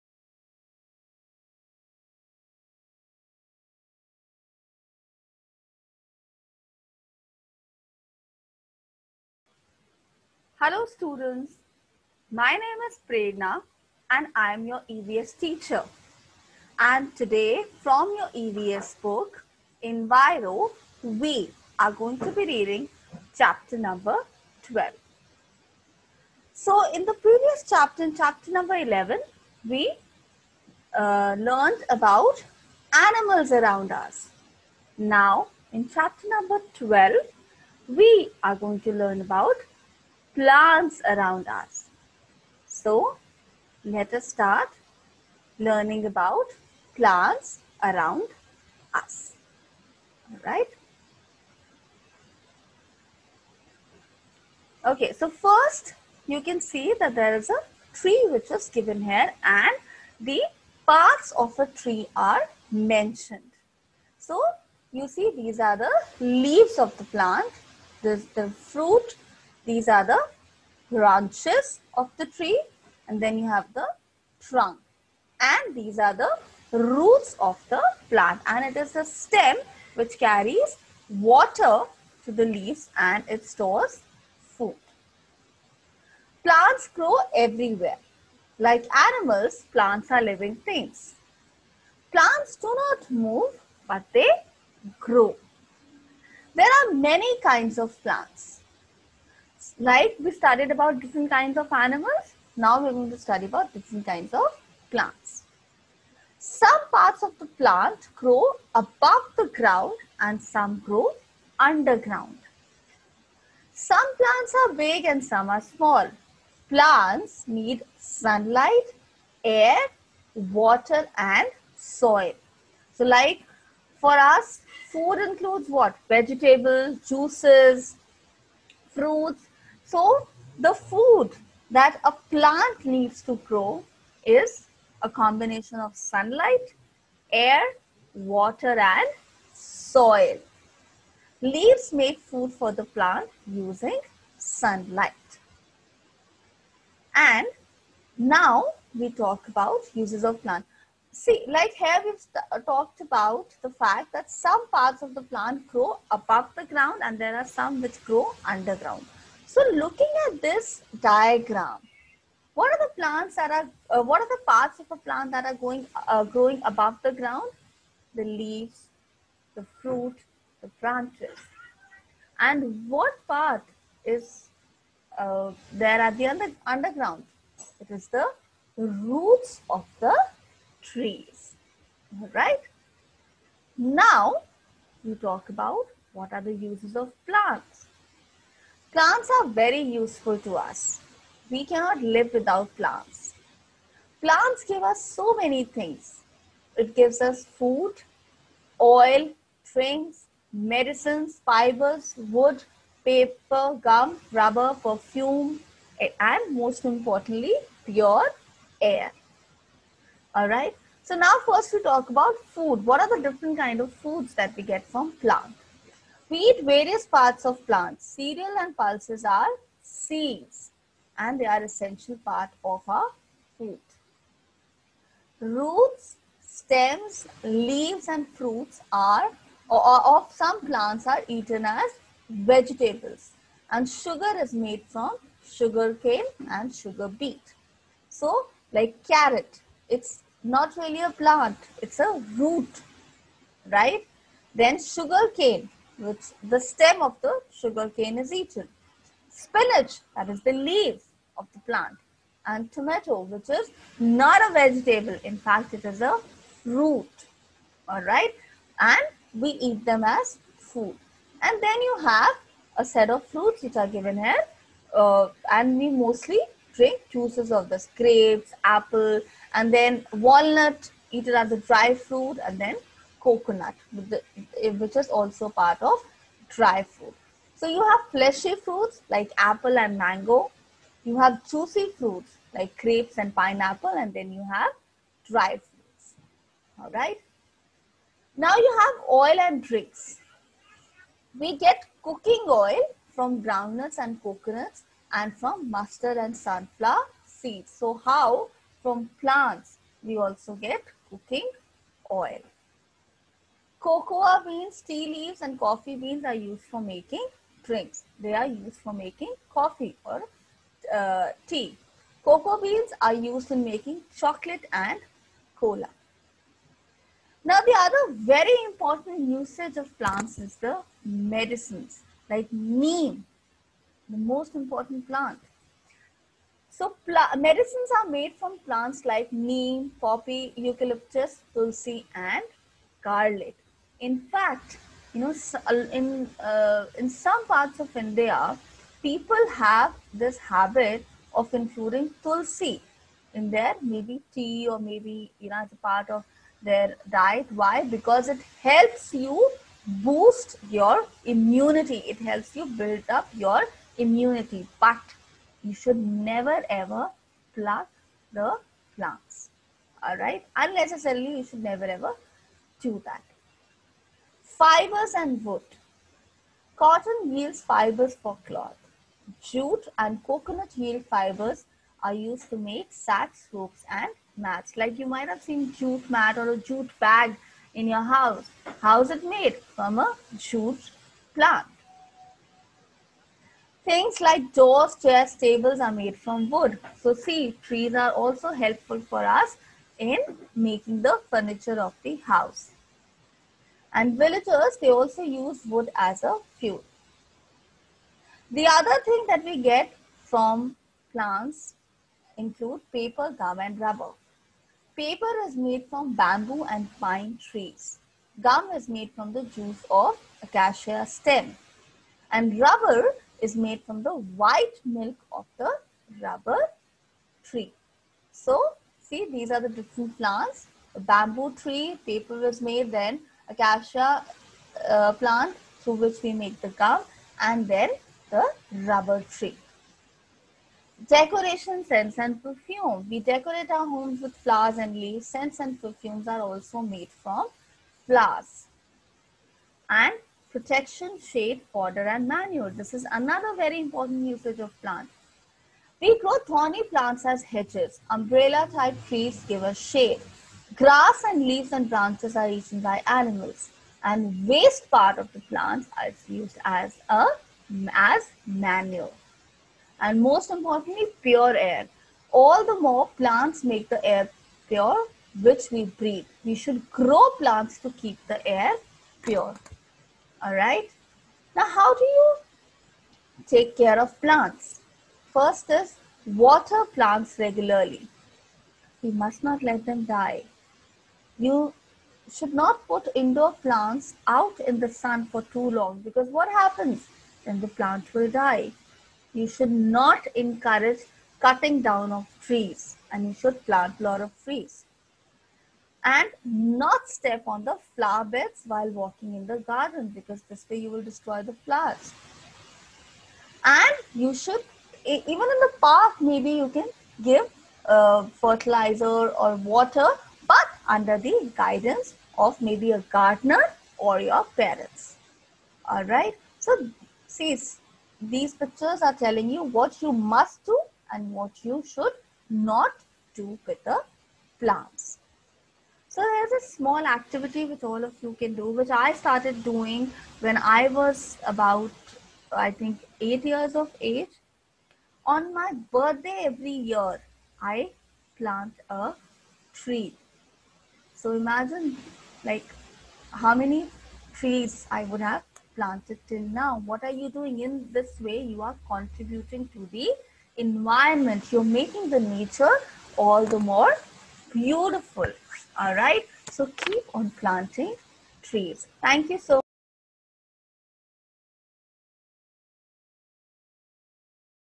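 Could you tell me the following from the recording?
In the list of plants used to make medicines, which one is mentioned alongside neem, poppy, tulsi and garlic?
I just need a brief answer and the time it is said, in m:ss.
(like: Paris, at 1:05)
eucalyptus, at 5:30.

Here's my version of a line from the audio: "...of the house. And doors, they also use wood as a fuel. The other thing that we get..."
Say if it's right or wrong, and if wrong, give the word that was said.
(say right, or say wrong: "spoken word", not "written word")
wrong: "villagers", not "doors".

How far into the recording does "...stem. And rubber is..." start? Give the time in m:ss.
6:51.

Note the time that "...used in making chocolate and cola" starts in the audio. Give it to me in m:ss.
5:13.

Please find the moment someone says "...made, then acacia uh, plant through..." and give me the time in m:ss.
7:02.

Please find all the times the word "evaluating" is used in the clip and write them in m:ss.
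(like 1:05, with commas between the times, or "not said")
not said.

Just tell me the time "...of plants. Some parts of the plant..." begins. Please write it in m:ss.
1:44.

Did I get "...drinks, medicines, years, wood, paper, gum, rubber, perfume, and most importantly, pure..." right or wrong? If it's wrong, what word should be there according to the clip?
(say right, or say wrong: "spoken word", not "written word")
wrong: "fibers", not "years".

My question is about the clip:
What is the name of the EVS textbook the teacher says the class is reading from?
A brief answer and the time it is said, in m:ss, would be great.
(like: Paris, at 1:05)
Enviro, at 0:19.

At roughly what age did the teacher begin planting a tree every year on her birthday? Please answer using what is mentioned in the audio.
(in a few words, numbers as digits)
8.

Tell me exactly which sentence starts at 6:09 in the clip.
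Jute and coconut yield fibers are used to make sacks, ropes and mats.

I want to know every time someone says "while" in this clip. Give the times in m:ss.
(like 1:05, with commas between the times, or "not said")
8:18.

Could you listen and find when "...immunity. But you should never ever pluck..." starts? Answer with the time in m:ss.
5:53.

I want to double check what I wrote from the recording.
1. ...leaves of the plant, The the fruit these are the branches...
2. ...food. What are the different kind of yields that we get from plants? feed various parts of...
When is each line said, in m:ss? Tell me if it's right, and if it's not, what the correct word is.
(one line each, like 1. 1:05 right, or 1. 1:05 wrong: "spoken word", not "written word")
1. 1:06 right
2. 3:32 wrong: "foods", not "yields".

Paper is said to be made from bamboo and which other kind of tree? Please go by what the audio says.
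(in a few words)
pine.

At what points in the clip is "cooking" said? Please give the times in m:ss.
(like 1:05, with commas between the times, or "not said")
4:52, 5:01.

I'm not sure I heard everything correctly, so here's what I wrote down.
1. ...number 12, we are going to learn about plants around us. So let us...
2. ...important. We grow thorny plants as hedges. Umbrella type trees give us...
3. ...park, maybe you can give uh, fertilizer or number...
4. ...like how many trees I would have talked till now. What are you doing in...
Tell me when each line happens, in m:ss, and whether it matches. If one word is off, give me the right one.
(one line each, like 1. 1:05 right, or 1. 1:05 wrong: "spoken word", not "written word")
1. 0:36 right
2. 7:24 wrong: "plant", not "important"
3. 8:25 wrong: "water", not "number"
4. 9:02 wrong: "planted", not "talked".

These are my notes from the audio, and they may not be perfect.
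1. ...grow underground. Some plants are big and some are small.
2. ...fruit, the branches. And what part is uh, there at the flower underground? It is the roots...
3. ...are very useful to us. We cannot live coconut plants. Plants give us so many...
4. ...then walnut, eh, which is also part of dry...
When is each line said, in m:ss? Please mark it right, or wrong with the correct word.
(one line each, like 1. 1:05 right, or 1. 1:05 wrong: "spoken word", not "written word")
1. 1:50 right
2. 2:49 wrong: "under", not "flower"
3. 3:09 wrong: "without", not "coconut"
4. 4:32 wrong: "coconut", not "walnut".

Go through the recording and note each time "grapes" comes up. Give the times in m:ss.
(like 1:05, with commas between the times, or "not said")
4:27, 4:42.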